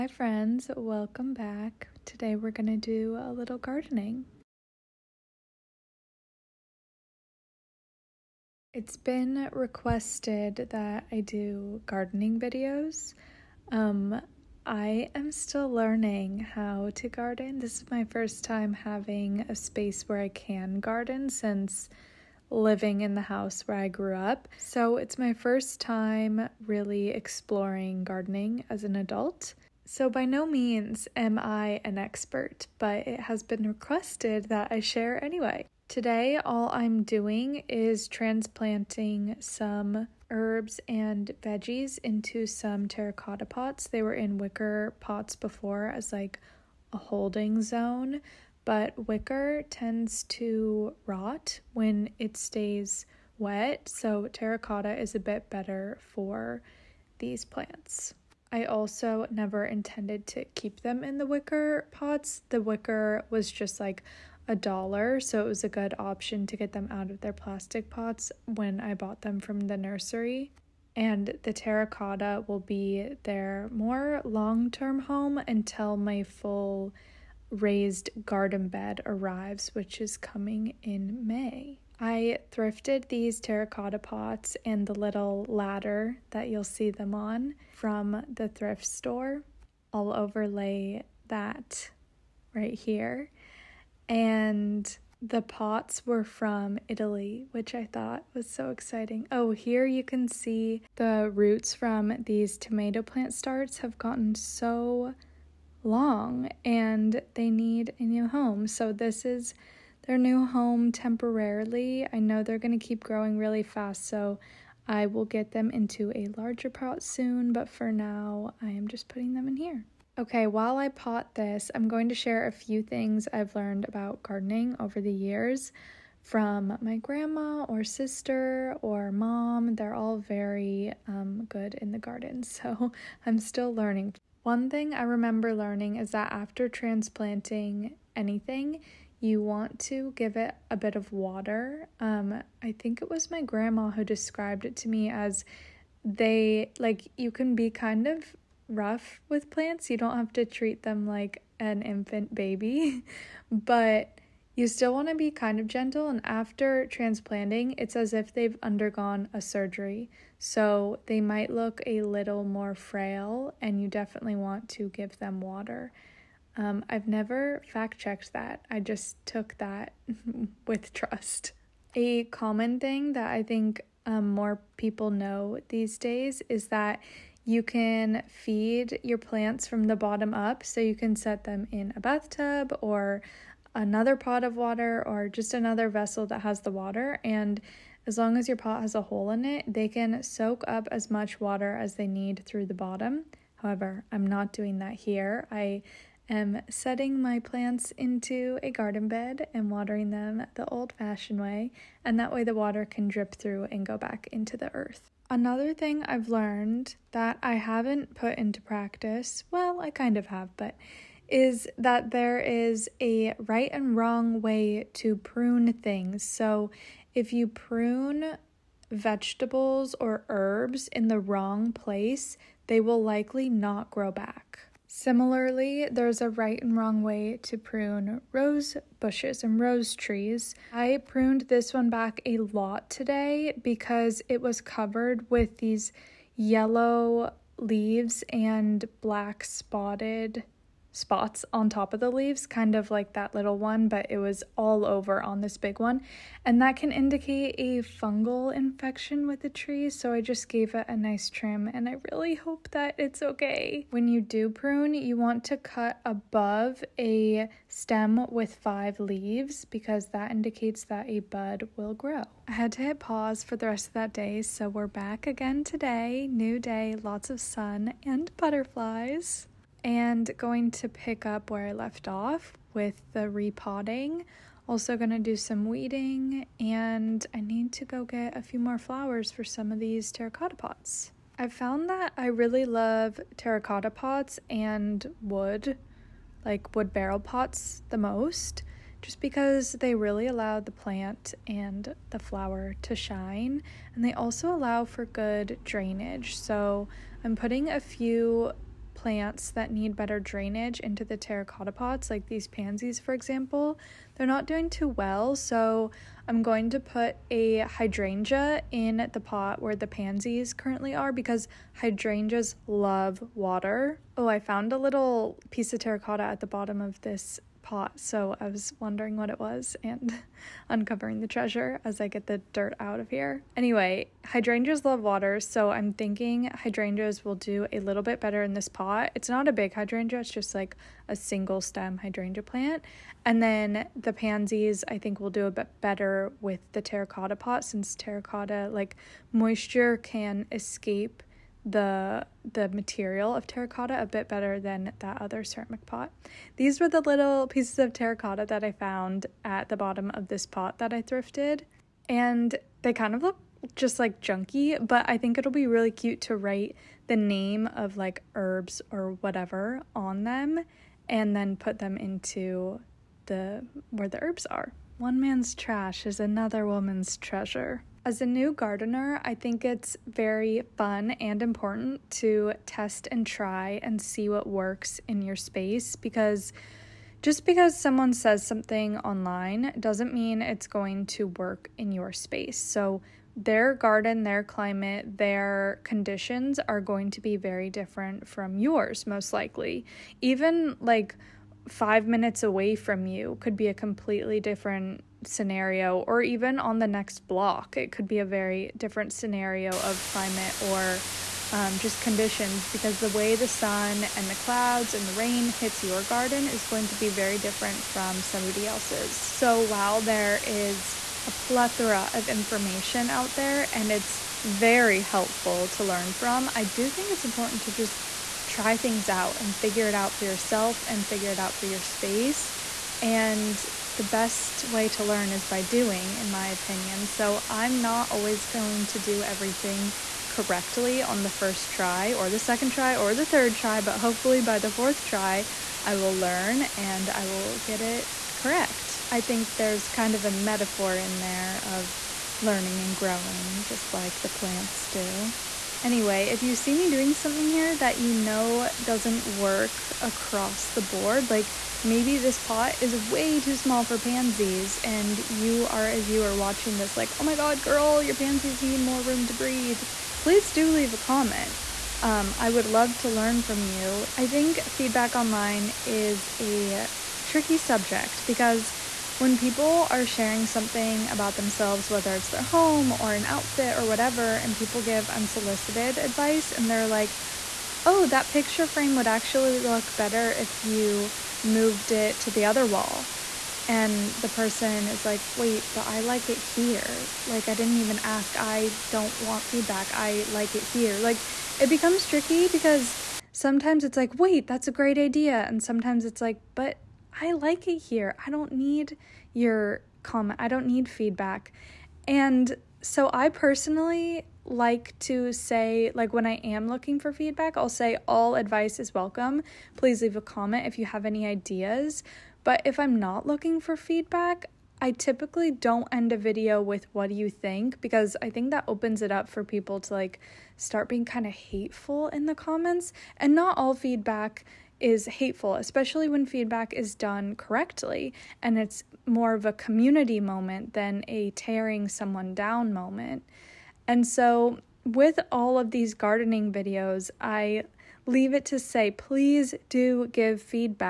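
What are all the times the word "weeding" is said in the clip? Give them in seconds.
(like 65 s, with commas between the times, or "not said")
275 s.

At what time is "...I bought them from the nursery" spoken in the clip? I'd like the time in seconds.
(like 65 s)
68 s.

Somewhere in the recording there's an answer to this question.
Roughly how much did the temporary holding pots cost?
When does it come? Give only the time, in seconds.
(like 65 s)
63 s.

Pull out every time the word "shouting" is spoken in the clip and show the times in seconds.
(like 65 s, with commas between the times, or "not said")
not said.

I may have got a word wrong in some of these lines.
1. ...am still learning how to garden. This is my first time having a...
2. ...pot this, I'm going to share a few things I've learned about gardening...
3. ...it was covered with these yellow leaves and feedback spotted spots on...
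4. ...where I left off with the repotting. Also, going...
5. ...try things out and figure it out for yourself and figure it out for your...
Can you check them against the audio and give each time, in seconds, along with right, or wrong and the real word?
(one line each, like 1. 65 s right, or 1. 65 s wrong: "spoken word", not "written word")
1. 15 s right
2. 120 s right
3. 234 s wrong: "black", not "feedback"
4. 271 s right
5. 418 s right.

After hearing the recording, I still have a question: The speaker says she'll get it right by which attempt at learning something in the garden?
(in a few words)
The fourth.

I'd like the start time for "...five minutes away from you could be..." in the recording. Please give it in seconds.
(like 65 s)
391 s.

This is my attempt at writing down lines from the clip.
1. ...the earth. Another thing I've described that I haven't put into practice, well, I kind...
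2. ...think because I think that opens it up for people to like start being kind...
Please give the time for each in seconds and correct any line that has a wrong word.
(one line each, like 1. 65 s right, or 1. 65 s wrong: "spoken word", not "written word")
1. 204 s wrong: "learned", not "described"
2. 517 s right.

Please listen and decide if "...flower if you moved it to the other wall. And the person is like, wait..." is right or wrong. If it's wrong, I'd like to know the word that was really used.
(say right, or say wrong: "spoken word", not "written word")
wrong: "better", not "flower".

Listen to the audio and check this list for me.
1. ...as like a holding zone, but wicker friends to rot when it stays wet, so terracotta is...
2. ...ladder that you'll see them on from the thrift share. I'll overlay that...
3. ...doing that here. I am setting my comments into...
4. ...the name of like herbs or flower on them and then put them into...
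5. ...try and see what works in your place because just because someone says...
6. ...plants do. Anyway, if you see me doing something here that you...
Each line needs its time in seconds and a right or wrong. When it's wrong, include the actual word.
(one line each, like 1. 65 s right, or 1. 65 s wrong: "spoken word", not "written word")
1. 45 s wrong: "tends", not "friends"
2. 85 s wrong: "store", not "share"
3. 194 s wrong: "plants", not "comments"
4. 357 s wrong: "whatever", not "flower"
5. 373 s wrong: "space", not "place"
6. 444 s right.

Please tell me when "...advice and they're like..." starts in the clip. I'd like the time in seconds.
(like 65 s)
475 s.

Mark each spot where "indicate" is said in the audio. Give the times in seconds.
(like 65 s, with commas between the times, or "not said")
246 s, 260 s.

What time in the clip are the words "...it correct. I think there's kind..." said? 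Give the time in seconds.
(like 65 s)
437 s.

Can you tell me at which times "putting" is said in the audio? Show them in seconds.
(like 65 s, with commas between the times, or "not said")
119 s, 297 s.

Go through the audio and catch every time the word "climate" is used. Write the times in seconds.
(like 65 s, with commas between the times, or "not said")
384 s, 400 s.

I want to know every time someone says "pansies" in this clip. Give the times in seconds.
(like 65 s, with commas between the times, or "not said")
302 s, 309 s, 334 s, 453 s, 458 s.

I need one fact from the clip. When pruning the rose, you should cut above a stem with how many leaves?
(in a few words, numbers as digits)
5.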